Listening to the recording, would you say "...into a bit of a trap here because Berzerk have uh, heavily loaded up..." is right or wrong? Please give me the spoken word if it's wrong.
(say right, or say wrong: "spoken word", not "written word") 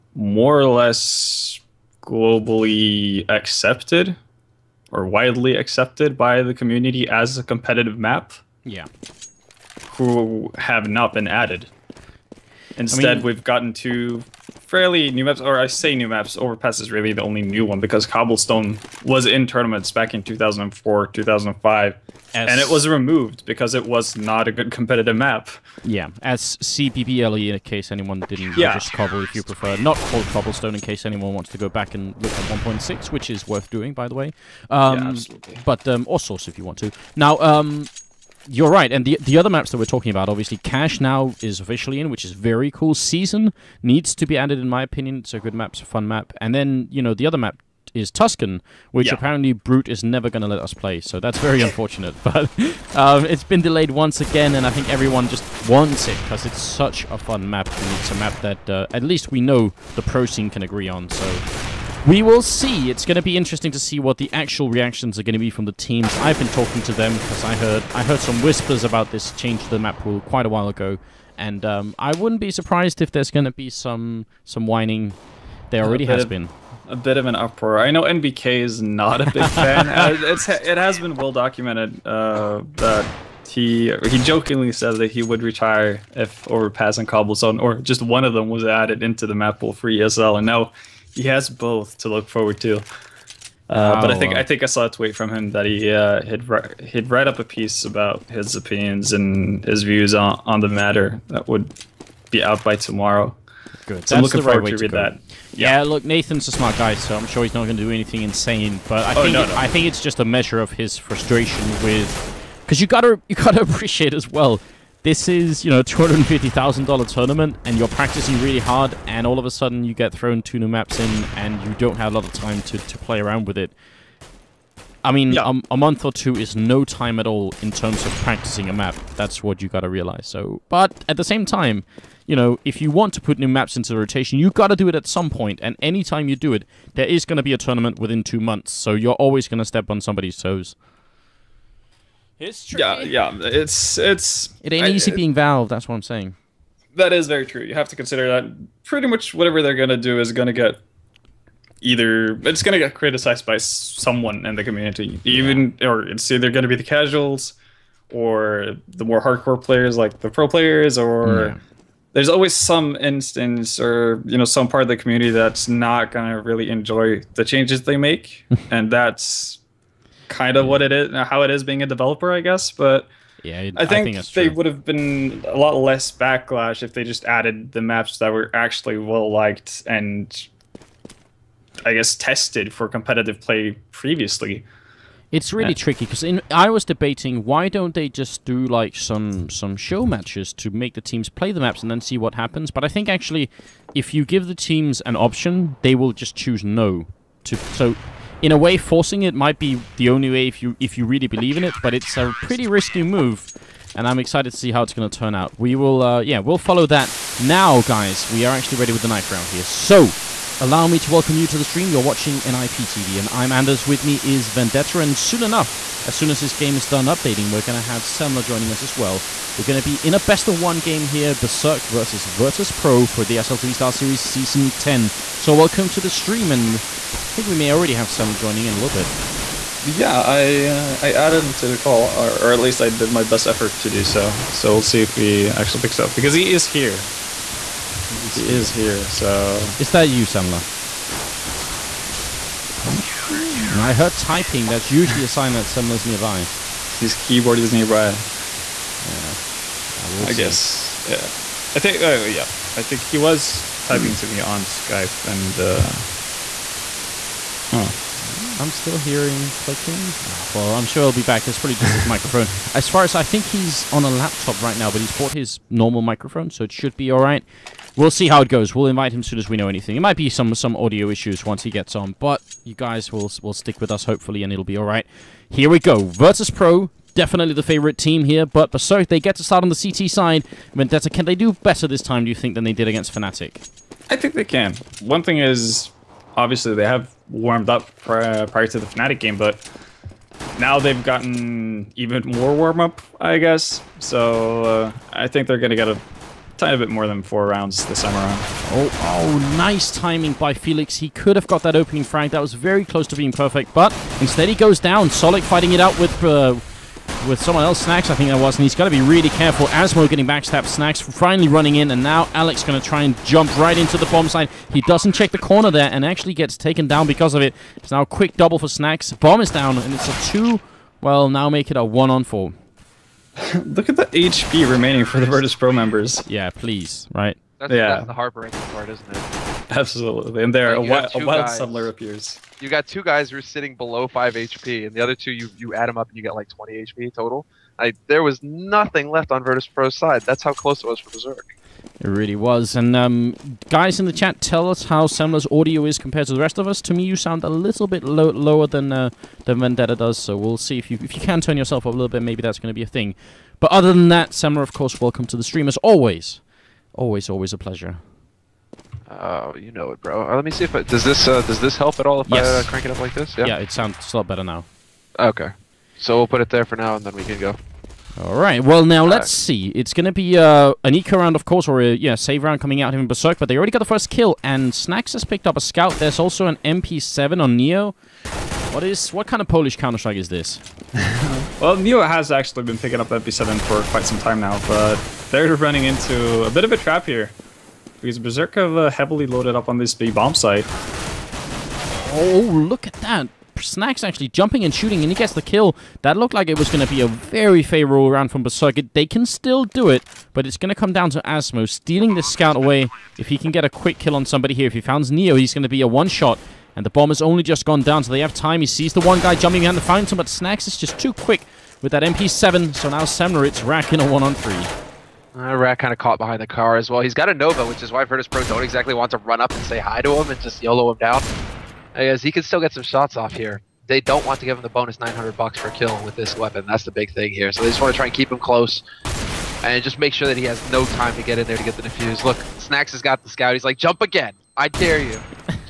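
right.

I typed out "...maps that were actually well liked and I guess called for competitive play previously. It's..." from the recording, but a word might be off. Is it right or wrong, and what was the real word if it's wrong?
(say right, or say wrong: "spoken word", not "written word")
wrong: "tested", not "called".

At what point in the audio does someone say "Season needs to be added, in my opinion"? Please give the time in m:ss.
0:42.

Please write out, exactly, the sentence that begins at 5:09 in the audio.
Asmo getting backstabbed, Snax finally running in, and now Alex going to try and jump right into the bomb side.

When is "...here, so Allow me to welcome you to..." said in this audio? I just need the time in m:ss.
3:29.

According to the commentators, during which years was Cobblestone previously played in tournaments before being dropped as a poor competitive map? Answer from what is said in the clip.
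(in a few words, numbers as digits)
2004, 2005.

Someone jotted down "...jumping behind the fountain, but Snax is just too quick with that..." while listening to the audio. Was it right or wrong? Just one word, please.
right.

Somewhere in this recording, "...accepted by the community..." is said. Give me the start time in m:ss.
0:05.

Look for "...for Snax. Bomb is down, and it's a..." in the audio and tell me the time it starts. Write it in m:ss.
5:18.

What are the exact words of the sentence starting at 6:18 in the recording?
What is what kind of Polish Counter Strike is this?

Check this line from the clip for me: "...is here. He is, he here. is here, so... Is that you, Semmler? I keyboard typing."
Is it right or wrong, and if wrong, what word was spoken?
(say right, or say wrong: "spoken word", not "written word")
wrong: "heard", not "keyboard".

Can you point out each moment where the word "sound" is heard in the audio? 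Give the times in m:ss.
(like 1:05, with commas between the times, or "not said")
5:47, 6:03.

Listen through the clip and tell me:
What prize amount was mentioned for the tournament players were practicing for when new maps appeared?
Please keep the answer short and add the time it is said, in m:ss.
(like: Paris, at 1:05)
$250,000, at 1:55.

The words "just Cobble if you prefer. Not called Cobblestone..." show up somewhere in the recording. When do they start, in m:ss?
0:28.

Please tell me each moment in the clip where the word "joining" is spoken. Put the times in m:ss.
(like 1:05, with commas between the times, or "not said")
3:38, 3:48.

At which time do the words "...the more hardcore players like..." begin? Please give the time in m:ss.
2:38.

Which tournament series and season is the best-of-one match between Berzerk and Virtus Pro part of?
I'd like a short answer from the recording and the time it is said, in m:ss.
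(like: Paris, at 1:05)
SLTV Star Series Season 10, at 3:43.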